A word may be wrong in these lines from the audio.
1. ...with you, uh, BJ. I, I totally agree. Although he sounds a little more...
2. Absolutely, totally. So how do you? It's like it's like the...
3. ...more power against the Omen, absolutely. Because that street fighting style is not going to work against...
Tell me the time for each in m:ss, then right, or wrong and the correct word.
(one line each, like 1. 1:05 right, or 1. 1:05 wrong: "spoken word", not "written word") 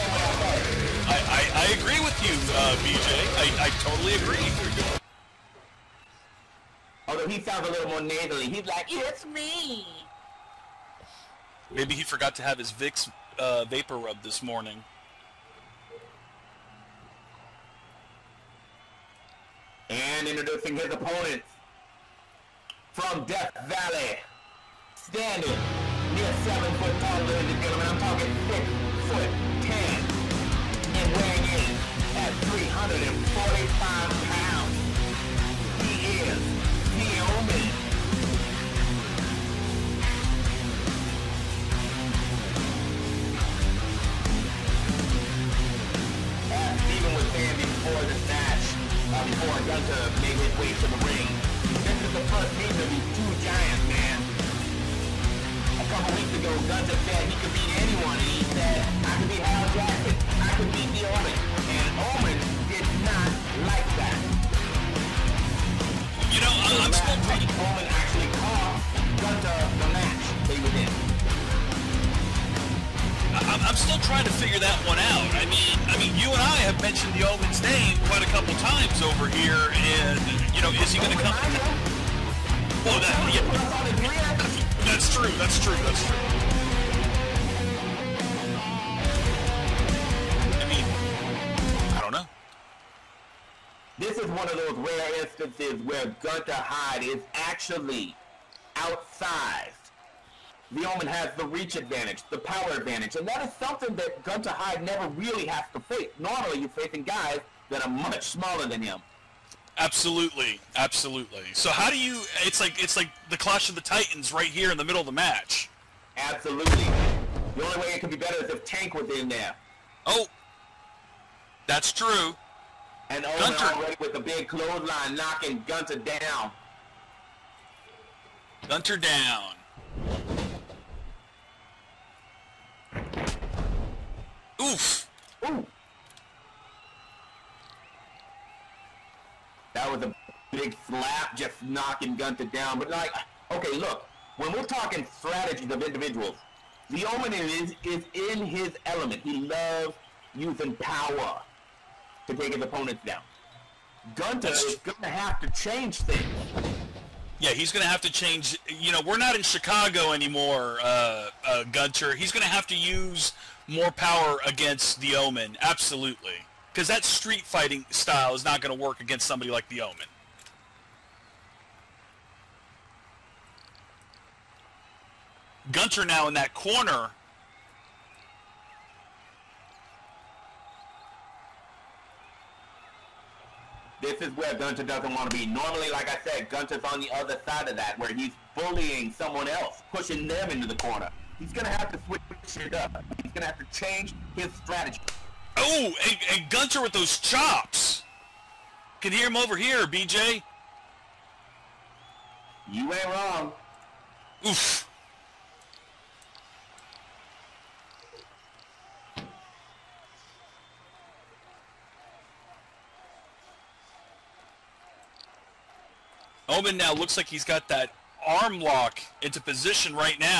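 1. 0:02 right
2. 1:49 wrong: "absolutely", not "totally"
3. 2:43 right.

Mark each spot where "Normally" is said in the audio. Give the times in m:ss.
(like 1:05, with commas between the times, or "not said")
1:46, 3:05.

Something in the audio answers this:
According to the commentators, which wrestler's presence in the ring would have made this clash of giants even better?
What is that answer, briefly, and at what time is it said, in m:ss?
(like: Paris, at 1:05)
Tank, at 1:58.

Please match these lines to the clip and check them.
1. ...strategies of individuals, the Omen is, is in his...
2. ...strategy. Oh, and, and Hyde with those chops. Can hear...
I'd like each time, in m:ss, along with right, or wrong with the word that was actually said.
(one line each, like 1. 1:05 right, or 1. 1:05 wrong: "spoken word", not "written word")
1. 2:25 right
2. 3:14 wrong: "Gunter", not "Hyde".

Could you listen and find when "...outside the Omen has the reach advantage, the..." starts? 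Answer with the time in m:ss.
1:38.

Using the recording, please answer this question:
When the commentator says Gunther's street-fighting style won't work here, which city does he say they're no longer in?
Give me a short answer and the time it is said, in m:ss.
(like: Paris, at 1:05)
Chicago, at 2:39.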